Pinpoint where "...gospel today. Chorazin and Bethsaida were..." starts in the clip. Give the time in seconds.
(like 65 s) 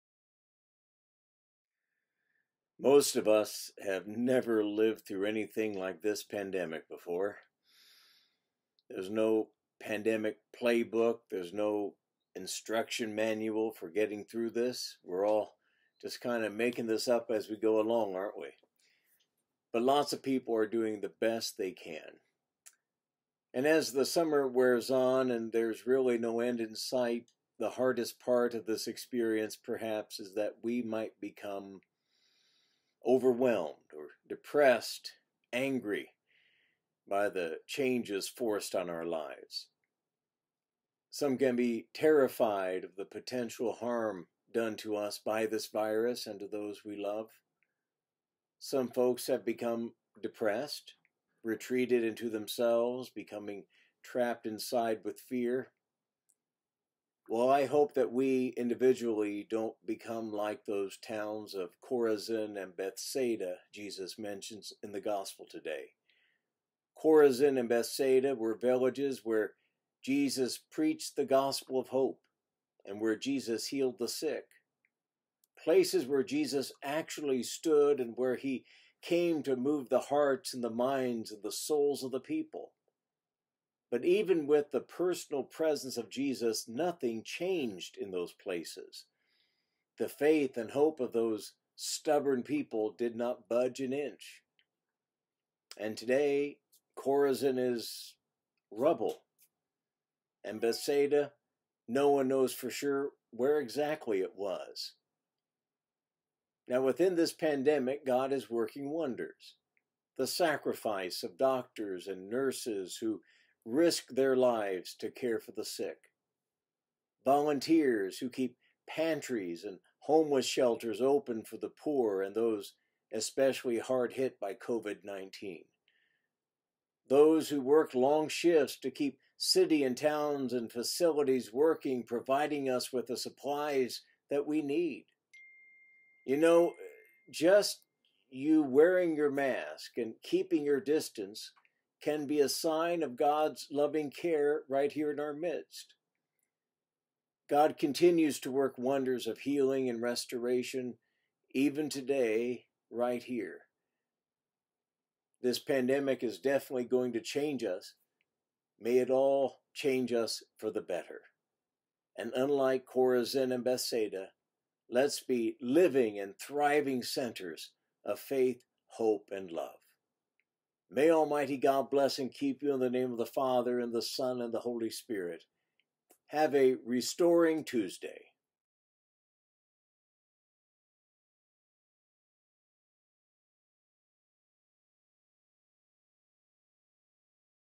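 64 s.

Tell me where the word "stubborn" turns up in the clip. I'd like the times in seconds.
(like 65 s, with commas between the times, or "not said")
91 s.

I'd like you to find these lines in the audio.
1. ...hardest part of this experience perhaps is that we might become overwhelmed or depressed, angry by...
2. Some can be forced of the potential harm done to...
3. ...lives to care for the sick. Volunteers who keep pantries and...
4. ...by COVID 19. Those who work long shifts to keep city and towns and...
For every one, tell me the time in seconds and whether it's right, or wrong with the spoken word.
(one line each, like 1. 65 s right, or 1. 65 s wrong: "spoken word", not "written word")
1. 27 s right
2. 41 s wrong: "terrified", not "forced"
3. 114 s right
4. 124 s right.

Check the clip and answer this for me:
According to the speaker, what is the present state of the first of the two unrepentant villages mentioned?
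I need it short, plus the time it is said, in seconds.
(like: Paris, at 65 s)
rubble, at 98 s.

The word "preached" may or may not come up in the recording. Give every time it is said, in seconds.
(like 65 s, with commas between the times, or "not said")
70 s.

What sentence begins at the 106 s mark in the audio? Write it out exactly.
Now, within this pandemic, God is working wonders.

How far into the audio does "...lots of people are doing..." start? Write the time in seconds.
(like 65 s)
19 s.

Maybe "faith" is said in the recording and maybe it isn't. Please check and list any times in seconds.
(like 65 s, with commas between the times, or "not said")
90 s, 168 s.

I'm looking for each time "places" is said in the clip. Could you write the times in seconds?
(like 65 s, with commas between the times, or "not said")
75 s, 88 s.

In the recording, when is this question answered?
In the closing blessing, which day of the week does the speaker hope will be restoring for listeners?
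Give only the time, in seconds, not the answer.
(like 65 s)
177 s.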